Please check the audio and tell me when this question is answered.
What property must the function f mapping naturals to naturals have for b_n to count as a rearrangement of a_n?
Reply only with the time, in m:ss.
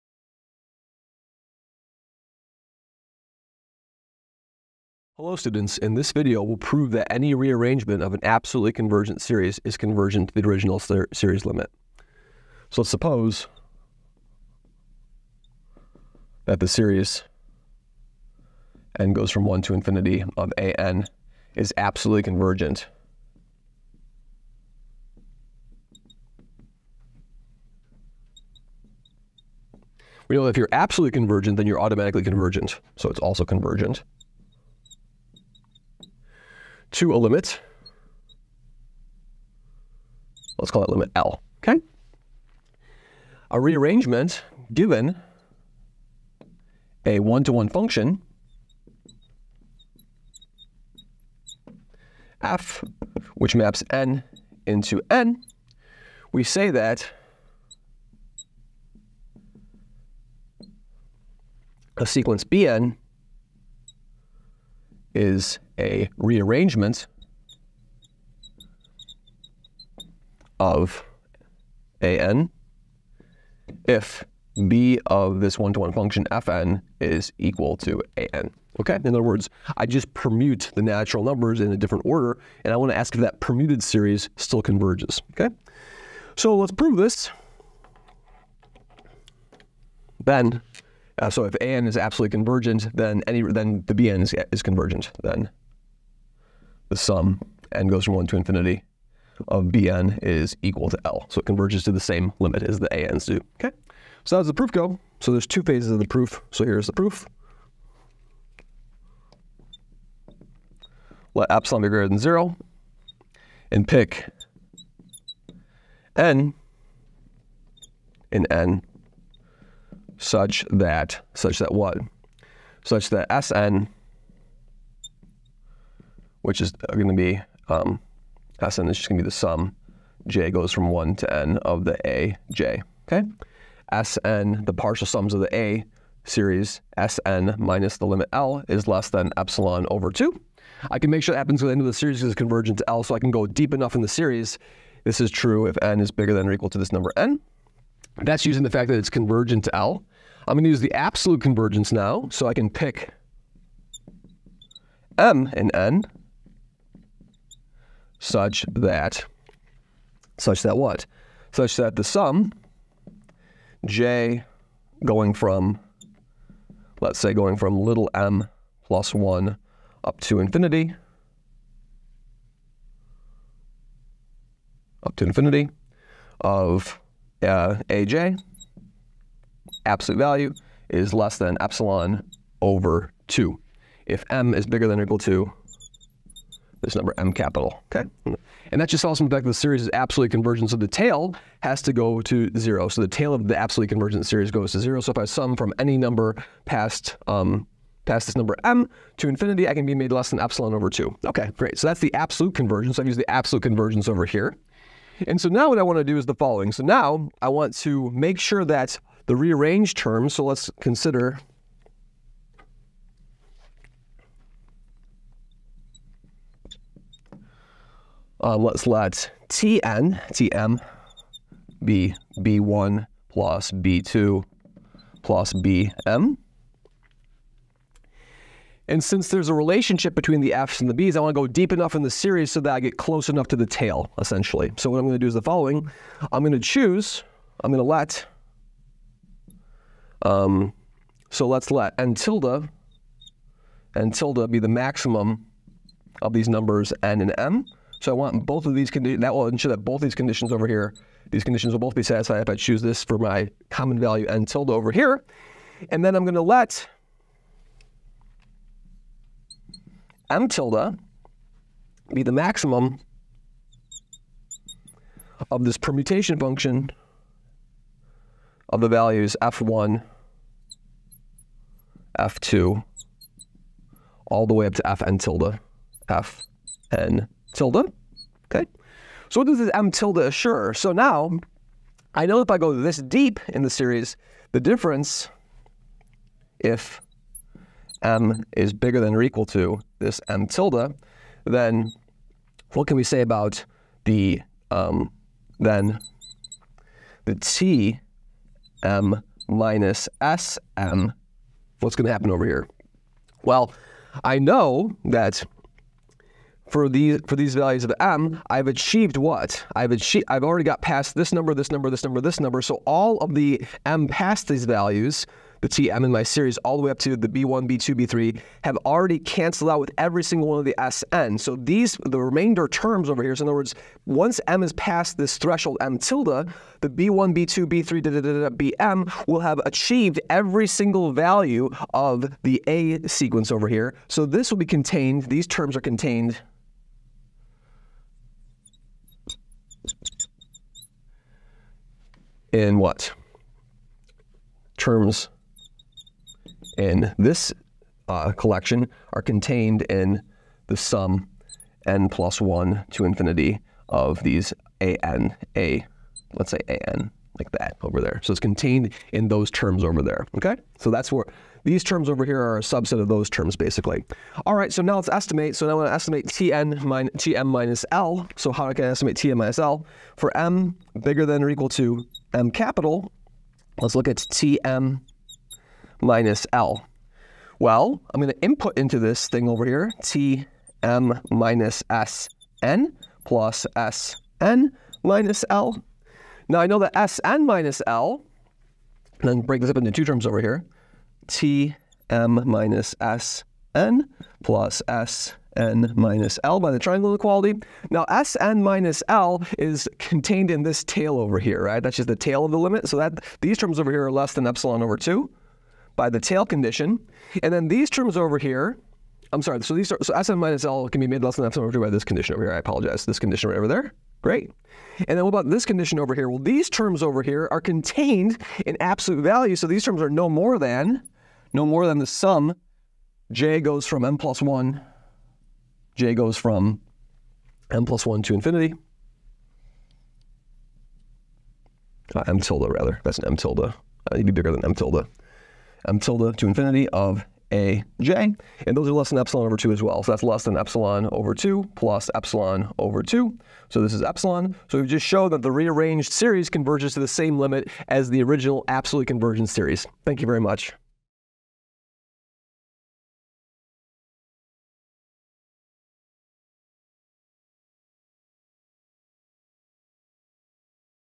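1:15.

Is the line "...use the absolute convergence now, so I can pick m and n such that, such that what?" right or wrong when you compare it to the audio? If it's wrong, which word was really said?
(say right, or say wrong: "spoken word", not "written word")
right.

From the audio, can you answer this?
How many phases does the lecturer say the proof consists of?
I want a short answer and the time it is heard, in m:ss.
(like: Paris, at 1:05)
2, at 1:45.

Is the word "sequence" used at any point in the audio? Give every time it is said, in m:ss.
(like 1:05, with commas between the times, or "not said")
1:02, 5:33.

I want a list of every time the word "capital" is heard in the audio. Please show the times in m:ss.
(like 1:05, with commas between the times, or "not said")
3:07, 6:12.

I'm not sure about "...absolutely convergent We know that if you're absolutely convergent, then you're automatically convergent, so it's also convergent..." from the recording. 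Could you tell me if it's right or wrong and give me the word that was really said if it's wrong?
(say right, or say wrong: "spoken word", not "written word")
right.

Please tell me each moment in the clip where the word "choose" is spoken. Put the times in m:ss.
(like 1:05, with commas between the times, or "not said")
3:56, 4:12.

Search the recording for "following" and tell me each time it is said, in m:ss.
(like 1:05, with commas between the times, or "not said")
3:26, 3:55.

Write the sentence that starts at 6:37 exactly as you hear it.
Now S N minus L is contained in this tail over here, right?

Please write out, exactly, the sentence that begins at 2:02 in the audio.
Such that Sn which is going to be um, Sn is just going to be the sum.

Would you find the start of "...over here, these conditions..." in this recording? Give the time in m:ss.
4:10.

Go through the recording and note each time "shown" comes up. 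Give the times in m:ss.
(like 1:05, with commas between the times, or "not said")
7:25.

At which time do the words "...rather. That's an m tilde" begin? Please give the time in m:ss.
7:12.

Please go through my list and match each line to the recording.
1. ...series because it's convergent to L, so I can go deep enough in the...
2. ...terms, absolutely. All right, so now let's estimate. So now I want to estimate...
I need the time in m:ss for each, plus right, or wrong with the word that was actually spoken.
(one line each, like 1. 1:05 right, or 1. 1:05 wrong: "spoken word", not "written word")
1. 2:21 right
2. 6:03 wrong: "basically", not "absolutely".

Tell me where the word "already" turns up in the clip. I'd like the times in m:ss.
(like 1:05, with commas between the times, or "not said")
5:10, 5:18.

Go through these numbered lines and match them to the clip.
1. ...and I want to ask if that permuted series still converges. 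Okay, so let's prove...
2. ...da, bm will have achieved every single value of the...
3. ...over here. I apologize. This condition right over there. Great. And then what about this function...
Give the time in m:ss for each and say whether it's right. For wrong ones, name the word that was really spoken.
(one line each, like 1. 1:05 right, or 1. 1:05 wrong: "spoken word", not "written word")
1. 1:22 right
2. 5:28 right
3. 6:52 wrong: "condition", not "function".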